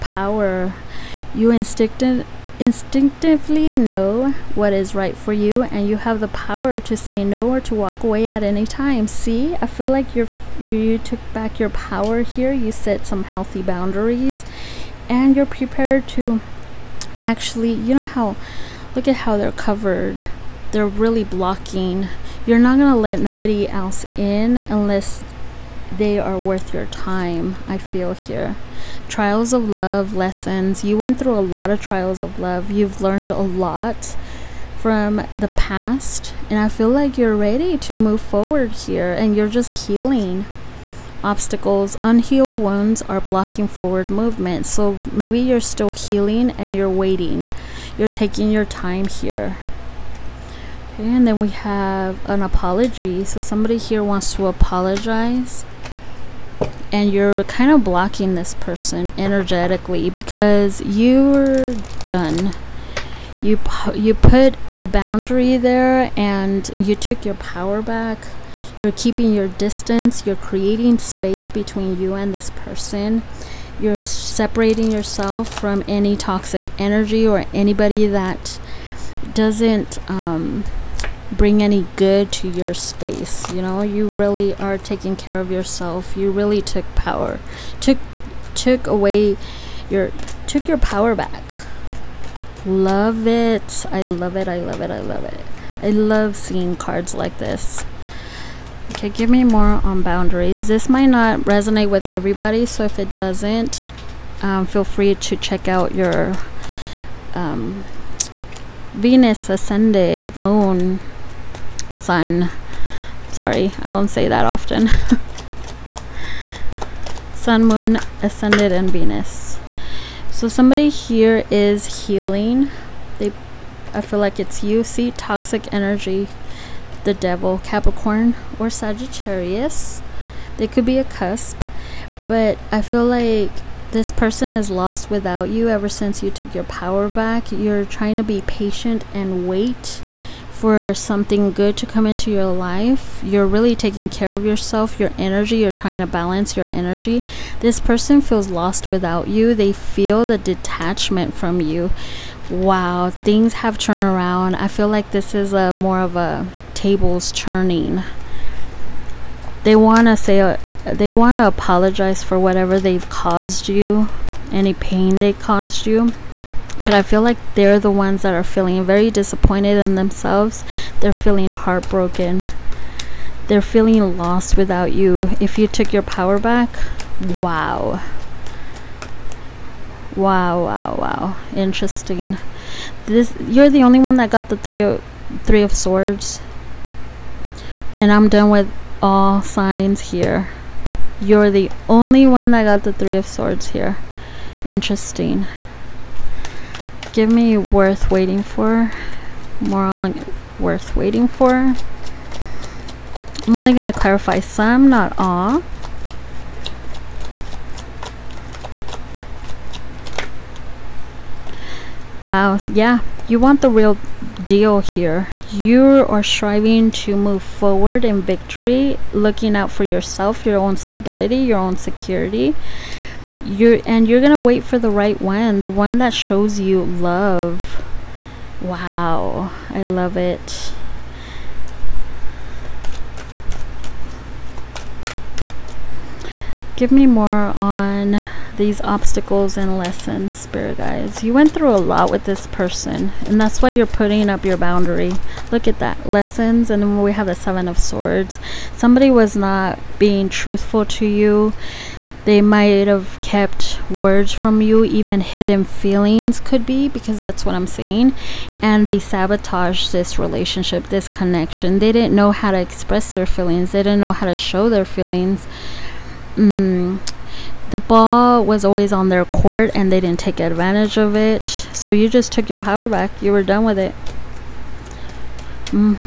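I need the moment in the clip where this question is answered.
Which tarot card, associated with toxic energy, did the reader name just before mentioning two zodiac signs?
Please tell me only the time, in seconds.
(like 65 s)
127 s.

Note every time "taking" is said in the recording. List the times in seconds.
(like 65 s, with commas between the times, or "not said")
48 s, 84 s, 143 s.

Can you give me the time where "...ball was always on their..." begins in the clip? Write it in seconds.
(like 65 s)
267 s.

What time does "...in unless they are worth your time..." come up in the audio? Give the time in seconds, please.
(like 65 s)
24 s.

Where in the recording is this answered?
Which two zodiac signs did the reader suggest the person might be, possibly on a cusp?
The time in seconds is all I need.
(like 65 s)
127 s.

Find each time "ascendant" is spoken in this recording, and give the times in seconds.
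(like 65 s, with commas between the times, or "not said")
109 s, 118 s.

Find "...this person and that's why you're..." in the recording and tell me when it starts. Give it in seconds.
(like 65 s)
242 s.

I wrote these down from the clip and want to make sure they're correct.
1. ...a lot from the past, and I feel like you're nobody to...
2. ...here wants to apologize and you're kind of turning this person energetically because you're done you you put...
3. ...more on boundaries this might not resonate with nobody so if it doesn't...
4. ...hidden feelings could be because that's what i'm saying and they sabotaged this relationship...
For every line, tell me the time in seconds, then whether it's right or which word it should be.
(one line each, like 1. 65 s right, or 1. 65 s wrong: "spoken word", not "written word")
1. 33 s wrong: "ready", not "nobody"
2. 53 s wrong: "blocking", not "turning"
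3. 99 s wrong: "everybody", not "nobody"
4. 255 s right.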